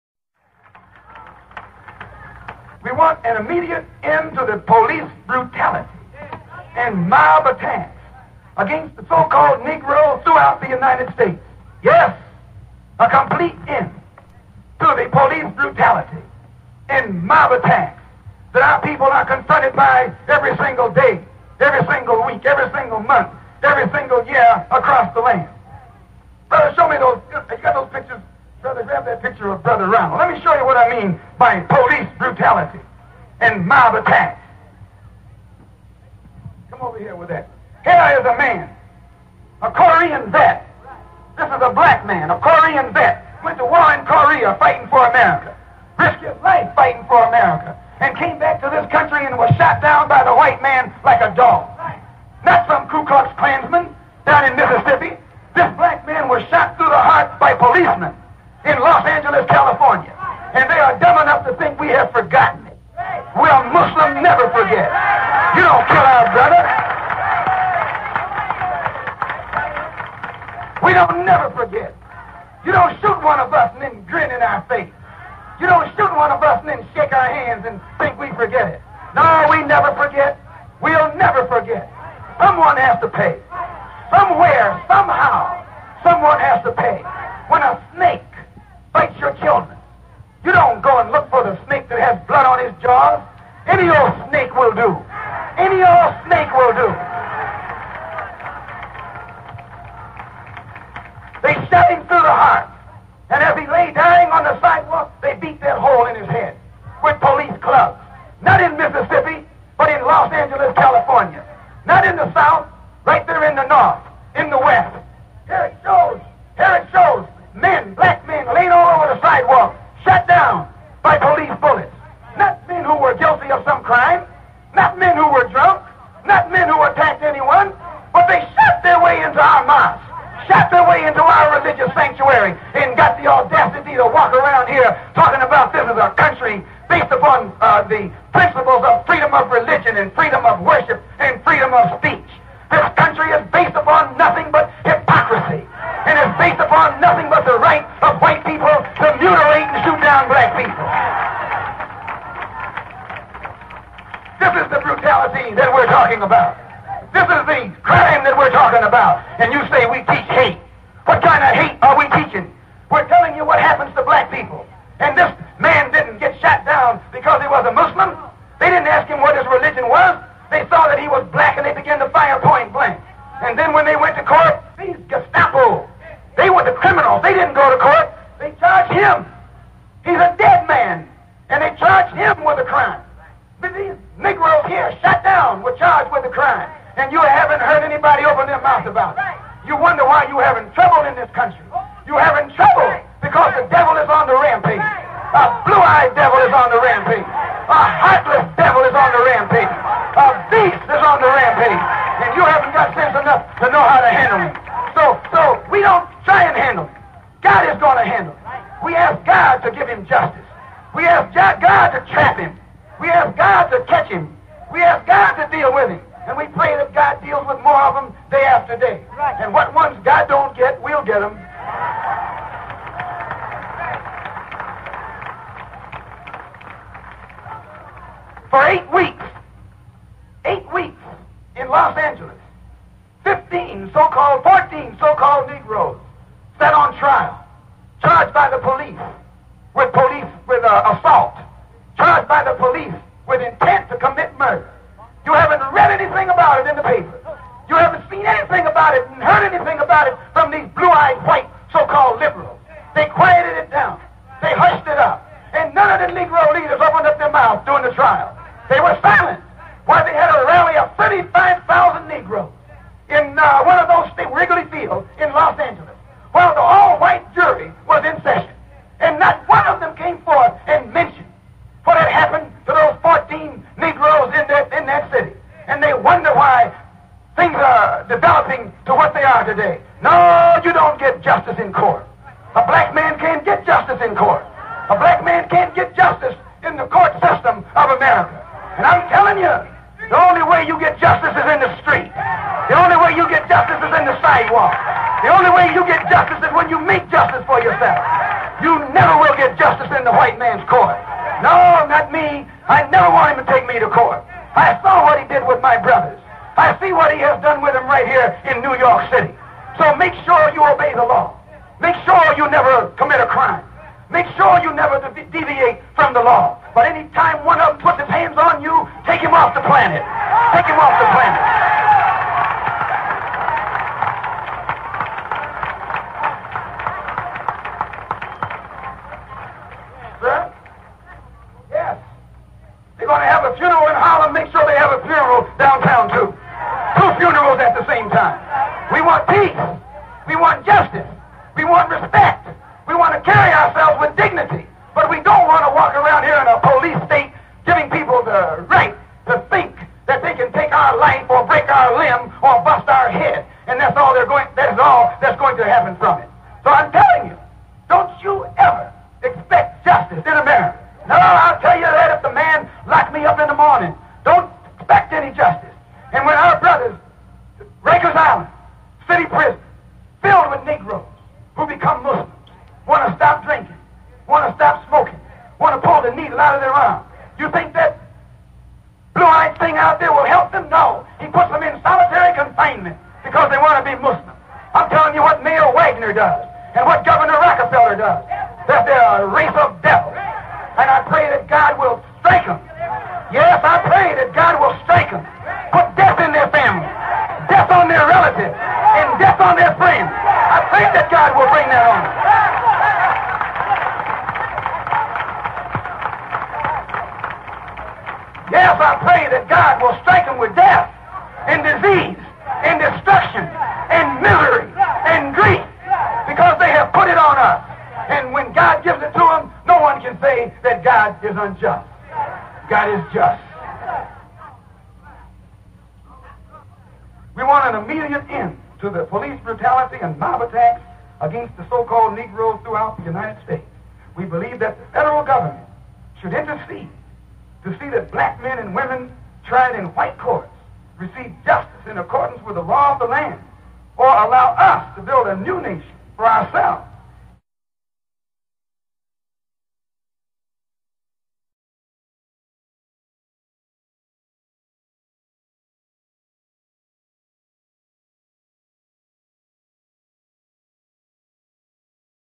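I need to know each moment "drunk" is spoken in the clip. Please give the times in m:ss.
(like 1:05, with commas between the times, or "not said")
2:05.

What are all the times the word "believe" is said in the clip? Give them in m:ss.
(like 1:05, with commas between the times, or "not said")
7:14.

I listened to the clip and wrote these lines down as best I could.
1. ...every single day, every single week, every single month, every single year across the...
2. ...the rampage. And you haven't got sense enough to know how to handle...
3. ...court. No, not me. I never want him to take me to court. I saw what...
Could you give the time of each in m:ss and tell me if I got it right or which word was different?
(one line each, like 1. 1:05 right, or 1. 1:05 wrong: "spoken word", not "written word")
1. 0:20 right
2. 3:21 right
3. 5:00 right.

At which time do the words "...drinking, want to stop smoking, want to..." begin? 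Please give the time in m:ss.
6:13.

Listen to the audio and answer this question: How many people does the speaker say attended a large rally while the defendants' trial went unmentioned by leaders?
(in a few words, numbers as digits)
35,000.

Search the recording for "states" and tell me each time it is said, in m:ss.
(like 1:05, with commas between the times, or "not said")
0:11, 4:24, 5:47, 7:13.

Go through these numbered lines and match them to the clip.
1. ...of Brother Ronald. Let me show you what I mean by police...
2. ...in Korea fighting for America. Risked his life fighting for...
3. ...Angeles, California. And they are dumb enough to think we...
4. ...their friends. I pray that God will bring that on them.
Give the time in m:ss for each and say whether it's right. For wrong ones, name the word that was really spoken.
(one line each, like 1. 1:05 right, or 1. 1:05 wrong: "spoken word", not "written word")
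1. 0:29 right
2. 0:43 right
3. 0:59 right
4. 6:39 right.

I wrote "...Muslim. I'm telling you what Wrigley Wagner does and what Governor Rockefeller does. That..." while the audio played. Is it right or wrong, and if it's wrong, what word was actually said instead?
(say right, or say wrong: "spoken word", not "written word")
wrong: "Mayor", not "Wrigley".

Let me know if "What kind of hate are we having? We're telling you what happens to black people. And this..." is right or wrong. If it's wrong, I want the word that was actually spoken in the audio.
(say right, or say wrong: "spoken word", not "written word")
wrong: "teaching", not "having".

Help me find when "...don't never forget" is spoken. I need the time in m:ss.
1:10.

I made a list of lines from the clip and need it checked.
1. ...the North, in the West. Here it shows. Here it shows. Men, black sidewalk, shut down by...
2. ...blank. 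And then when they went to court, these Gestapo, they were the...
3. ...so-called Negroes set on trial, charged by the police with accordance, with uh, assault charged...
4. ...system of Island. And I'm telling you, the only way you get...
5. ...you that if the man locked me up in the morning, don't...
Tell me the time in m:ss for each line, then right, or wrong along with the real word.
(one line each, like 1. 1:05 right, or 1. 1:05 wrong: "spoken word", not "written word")
1. 1:53 right
2. 2:52 right
3. 3:54 wrong: "police", not "accordance"
4. 4:47 wrong: "America", not "Island"
5. 6:01 right.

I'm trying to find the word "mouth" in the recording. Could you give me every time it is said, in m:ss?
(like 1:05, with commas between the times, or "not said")
3:08, 4:17.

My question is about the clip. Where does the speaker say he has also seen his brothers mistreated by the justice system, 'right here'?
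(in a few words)
New York City.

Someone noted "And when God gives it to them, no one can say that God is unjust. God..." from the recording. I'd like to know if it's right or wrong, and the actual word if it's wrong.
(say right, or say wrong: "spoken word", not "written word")
right.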